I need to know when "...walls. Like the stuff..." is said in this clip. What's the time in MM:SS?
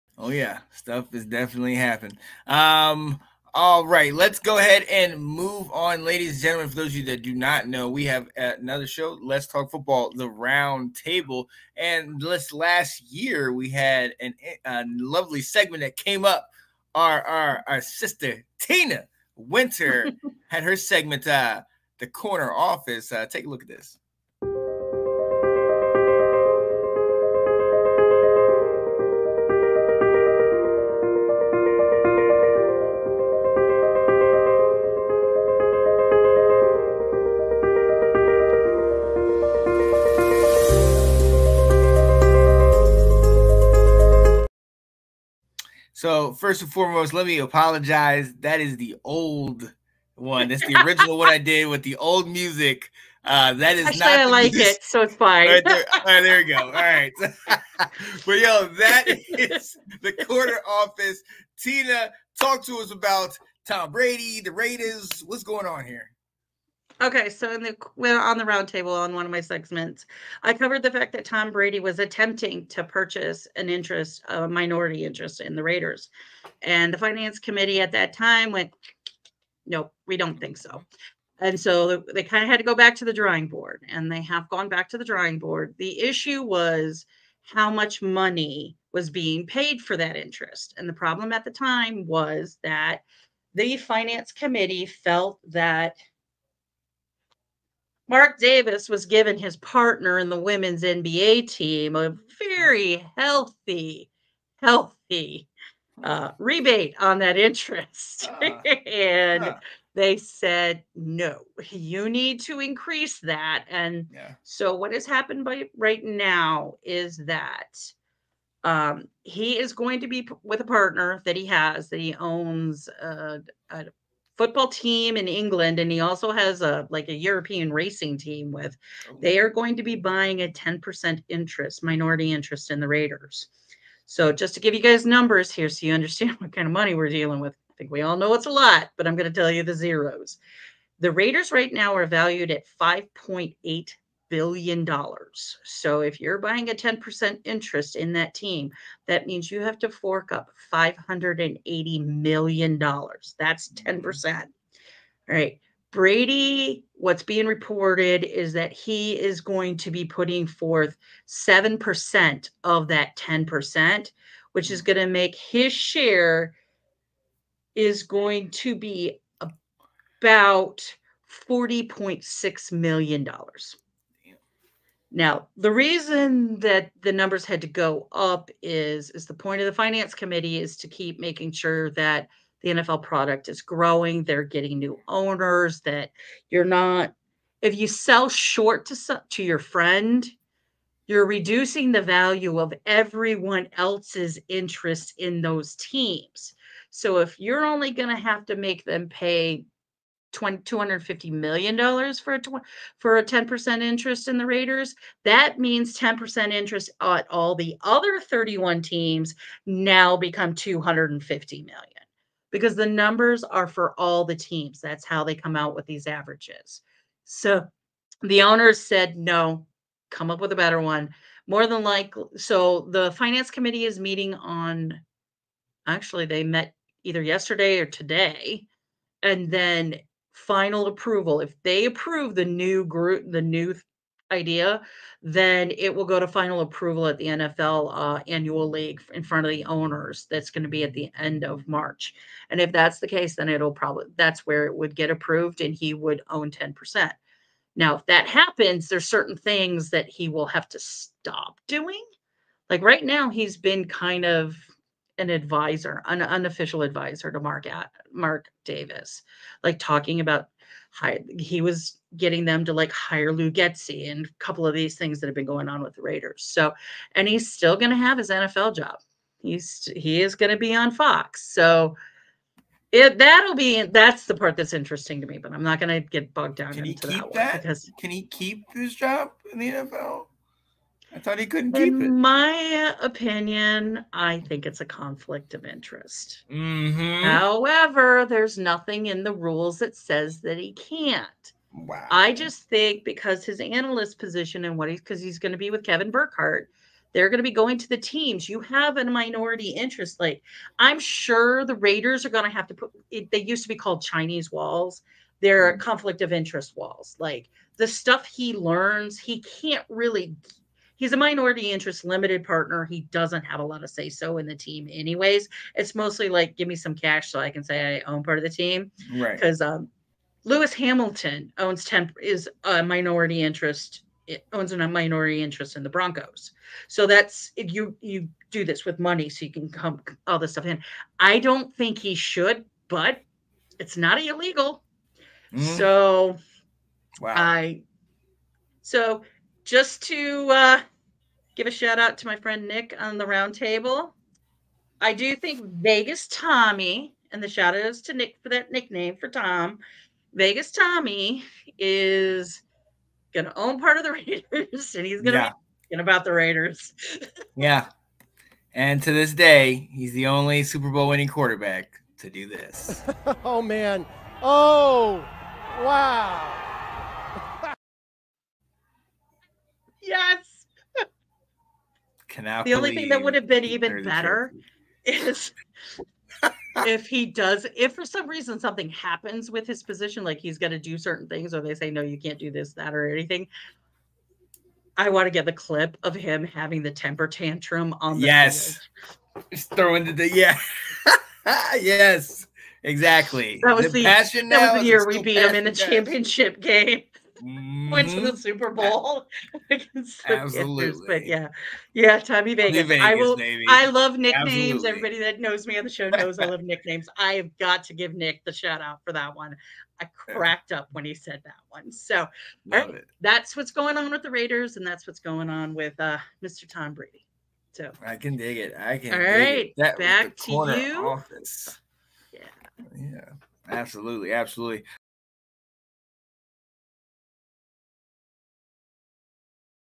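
05:06.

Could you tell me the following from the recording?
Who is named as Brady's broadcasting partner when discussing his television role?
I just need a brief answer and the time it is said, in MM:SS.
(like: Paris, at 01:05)
Kevin Burkhardt, at 04:55.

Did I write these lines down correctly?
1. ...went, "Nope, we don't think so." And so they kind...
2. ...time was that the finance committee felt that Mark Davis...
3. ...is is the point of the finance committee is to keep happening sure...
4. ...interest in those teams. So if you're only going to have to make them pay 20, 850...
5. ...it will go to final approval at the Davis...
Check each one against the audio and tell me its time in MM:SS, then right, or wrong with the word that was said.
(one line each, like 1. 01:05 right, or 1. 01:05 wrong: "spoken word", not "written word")
1. 01:18 right
2. 01:31 right
3. 02:58 wrong: "making", not "happening"
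4. 03:14 wrong: "250", not "850"
5. 03:55 wrong: "NFL", not "Davis".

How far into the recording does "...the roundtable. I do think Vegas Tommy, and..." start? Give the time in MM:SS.
05:43.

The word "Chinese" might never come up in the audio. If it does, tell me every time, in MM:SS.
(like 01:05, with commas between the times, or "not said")
05:04.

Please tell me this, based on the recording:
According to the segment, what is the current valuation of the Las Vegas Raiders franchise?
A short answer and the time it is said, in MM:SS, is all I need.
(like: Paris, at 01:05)
$5.8 billion, at 02:22.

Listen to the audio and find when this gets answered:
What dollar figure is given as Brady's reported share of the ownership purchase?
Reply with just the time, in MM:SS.
02:51.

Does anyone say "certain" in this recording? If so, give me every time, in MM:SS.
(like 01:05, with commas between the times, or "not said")
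04:09, 06:20.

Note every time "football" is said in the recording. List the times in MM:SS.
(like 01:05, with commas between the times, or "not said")
00:09, 02:04.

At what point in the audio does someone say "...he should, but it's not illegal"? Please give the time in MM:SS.
05:31.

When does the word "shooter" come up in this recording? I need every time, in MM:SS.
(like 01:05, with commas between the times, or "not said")
not said.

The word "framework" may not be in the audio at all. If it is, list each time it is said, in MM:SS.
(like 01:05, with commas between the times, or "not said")
not said.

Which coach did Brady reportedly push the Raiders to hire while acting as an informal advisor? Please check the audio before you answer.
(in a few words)
Luke Getsy.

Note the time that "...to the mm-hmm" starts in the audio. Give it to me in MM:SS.
06:38.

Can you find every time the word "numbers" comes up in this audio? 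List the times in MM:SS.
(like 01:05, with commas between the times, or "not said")
02:15, 02:57, 03:32.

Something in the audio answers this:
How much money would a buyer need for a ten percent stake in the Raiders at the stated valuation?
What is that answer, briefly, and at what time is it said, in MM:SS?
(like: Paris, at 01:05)
$580 million, at 02:30.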